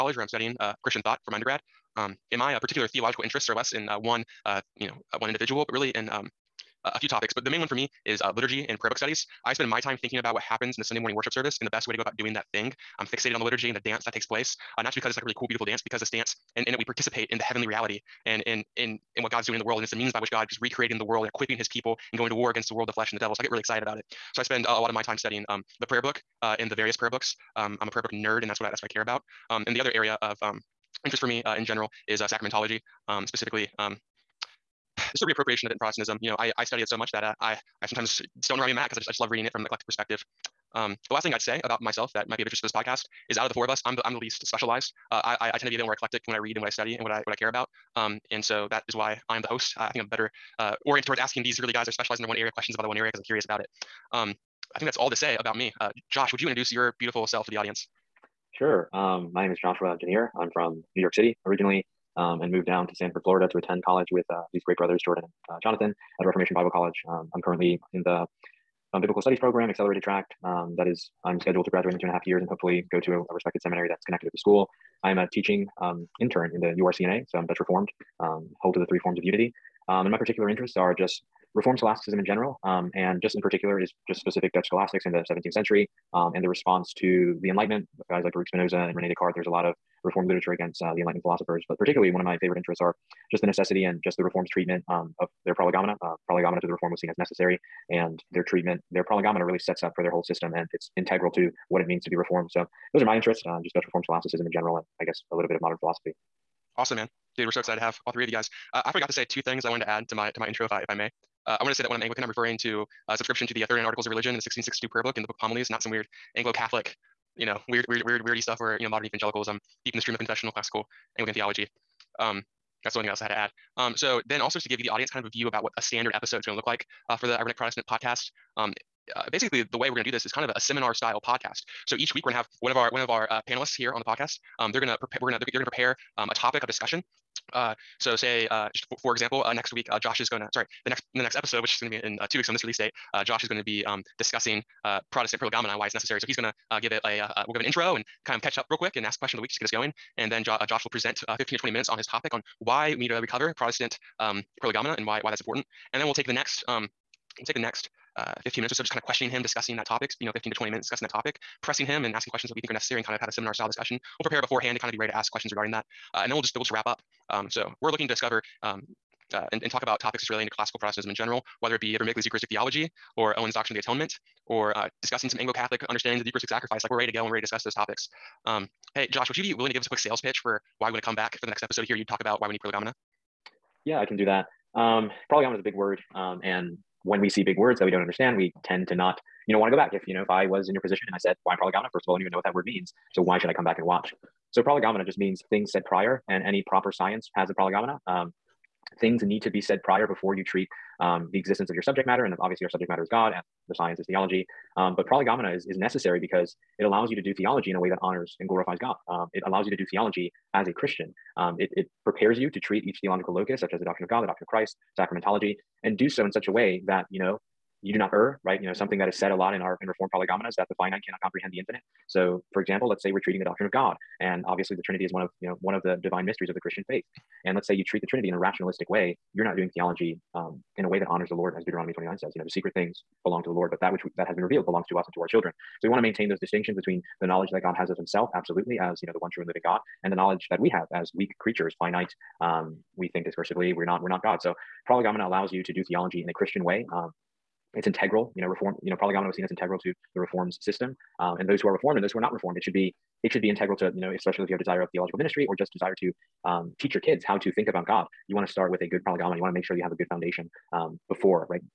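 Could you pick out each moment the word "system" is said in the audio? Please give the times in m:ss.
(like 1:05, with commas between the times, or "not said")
1:40, 4:10.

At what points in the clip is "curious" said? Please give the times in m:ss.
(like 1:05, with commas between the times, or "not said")
0:53.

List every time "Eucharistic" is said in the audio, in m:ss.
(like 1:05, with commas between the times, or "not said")
2:52, 2:56.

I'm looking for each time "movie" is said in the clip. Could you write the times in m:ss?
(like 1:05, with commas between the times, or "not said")
not said.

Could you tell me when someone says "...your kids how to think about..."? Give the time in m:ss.
4:16.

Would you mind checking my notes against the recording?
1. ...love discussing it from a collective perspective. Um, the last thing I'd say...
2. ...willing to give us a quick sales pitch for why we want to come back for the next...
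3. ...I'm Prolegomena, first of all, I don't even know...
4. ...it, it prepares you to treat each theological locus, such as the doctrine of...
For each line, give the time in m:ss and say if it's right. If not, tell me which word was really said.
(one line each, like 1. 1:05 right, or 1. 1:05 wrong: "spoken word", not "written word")
1. 0:39 wrong: "reading", not "discussing"
2. 2:59 right
3. 3:11 right
4. 3:31 right.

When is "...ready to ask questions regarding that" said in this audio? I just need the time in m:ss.
2:44.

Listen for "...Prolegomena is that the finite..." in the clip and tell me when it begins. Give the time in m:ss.
3:40.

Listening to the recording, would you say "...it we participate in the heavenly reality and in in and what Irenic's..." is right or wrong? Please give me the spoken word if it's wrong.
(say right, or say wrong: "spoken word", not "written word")
wrong: "God", not "Irenic".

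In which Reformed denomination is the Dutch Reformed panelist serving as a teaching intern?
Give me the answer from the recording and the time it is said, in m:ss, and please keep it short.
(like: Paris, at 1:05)
URCNA, at 1:16.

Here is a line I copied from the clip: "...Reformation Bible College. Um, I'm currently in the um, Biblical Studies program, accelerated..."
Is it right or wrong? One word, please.
right.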